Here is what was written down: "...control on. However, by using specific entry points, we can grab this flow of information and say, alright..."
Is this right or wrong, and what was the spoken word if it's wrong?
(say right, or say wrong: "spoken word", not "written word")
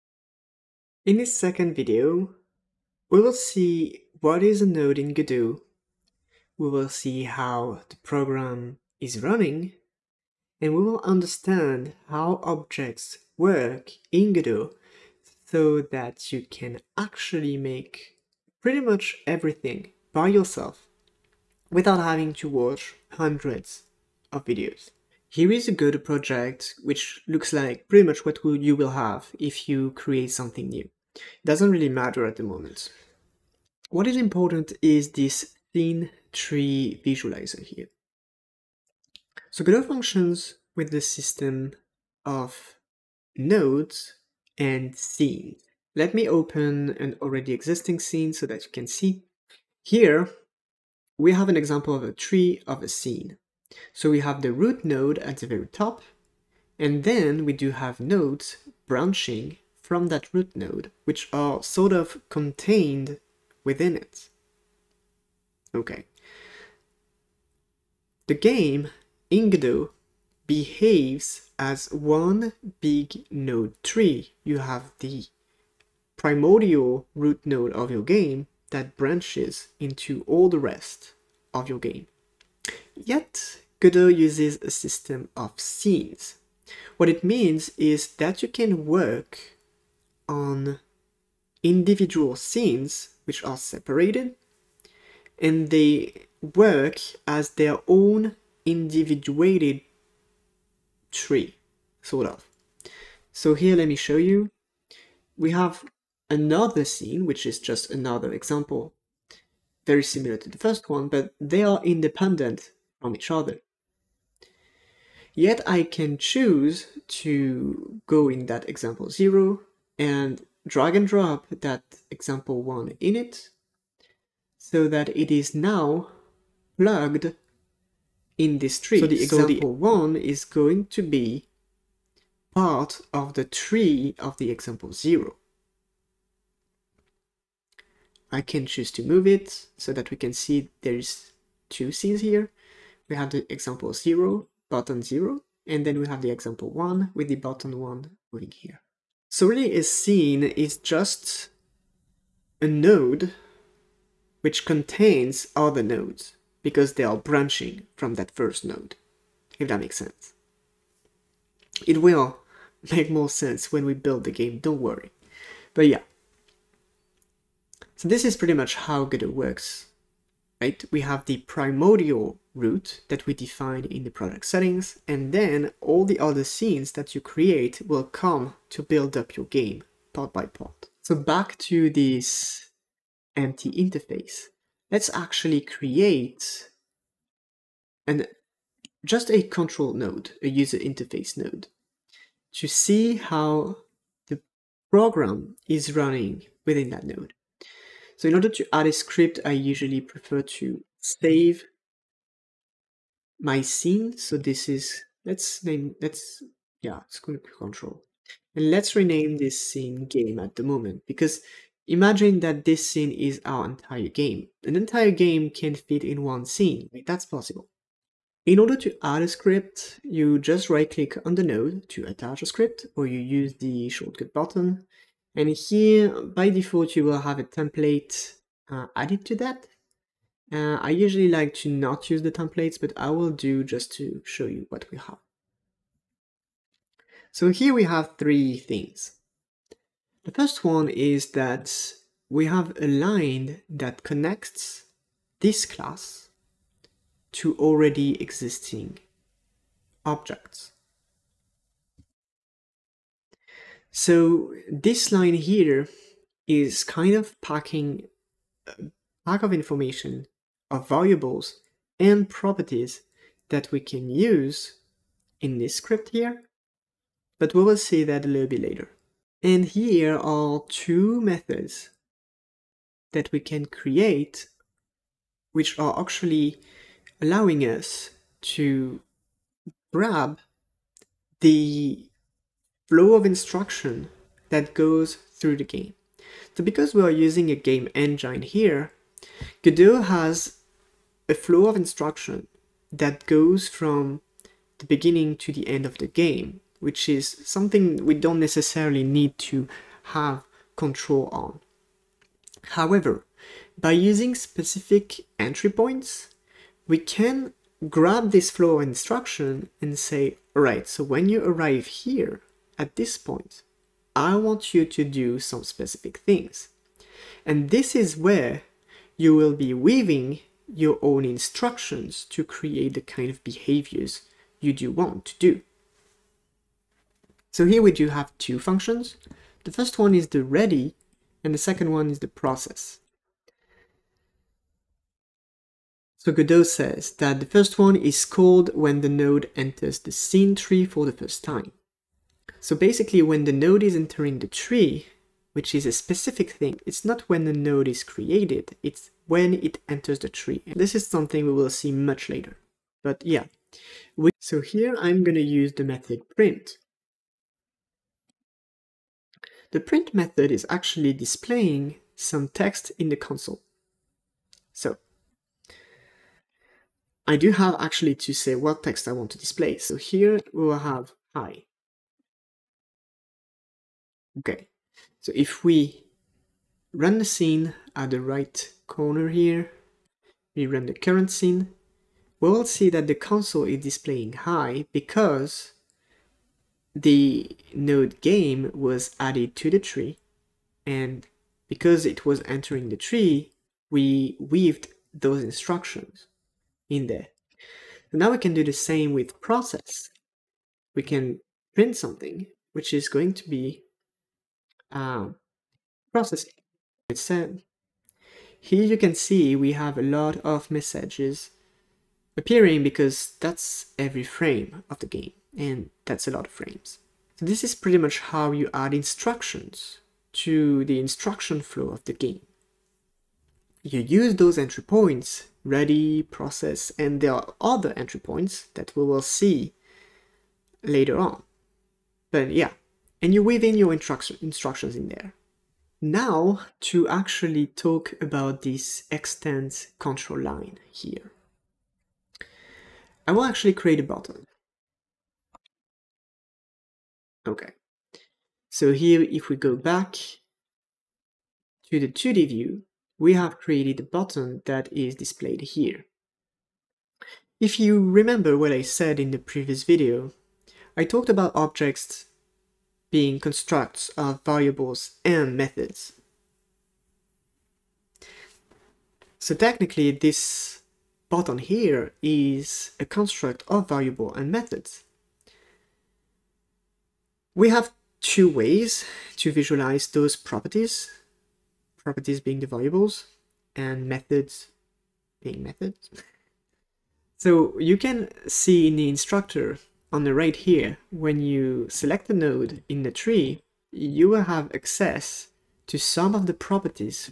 wrong: "instruction", not "information".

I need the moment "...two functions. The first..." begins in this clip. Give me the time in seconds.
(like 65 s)
328 s.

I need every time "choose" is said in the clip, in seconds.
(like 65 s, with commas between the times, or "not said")
116 s, 138 s.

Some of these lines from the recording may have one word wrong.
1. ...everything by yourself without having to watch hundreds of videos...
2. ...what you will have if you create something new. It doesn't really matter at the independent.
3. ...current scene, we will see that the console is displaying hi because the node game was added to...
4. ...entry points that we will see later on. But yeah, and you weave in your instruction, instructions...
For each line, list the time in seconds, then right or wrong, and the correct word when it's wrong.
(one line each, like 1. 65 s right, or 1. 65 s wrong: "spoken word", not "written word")
1. 19 s right
2. 28 s wrong: "moment", not "independent"
3. 380 s right
4. 427 s right.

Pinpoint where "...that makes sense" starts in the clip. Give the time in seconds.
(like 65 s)
159 s.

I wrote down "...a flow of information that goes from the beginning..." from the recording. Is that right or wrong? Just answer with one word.
wrong.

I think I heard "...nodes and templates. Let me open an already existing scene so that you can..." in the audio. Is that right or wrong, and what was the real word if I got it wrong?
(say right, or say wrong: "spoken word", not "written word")
wrong: "scenes", not "templates".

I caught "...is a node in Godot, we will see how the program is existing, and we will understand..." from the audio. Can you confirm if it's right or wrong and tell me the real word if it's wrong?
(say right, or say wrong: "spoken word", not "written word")
wrong: "running", not "existing".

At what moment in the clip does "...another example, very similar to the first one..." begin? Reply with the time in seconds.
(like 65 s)
107 s.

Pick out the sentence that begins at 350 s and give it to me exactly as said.
This is something we will see much later.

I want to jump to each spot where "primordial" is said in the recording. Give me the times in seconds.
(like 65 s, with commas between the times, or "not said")
76 s, 171 s.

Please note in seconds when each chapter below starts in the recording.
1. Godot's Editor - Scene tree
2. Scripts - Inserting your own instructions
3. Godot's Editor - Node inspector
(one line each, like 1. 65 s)
1. 25 s
2. 180 s
3. 441 s.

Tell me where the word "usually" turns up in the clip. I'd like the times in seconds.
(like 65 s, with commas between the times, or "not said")
199 s, 230 s.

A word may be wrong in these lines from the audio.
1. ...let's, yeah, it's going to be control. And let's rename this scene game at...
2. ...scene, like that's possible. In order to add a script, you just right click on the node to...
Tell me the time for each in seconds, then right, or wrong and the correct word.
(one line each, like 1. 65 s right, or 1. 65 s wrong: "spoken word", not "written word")
1. 206 s right
2. 216 s right.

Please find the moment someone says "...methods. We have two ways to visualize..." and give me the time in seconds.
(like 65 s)
474 s.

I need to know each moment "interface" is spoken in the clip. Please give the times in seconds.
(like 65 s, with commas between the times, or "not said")
183 s, 190 s.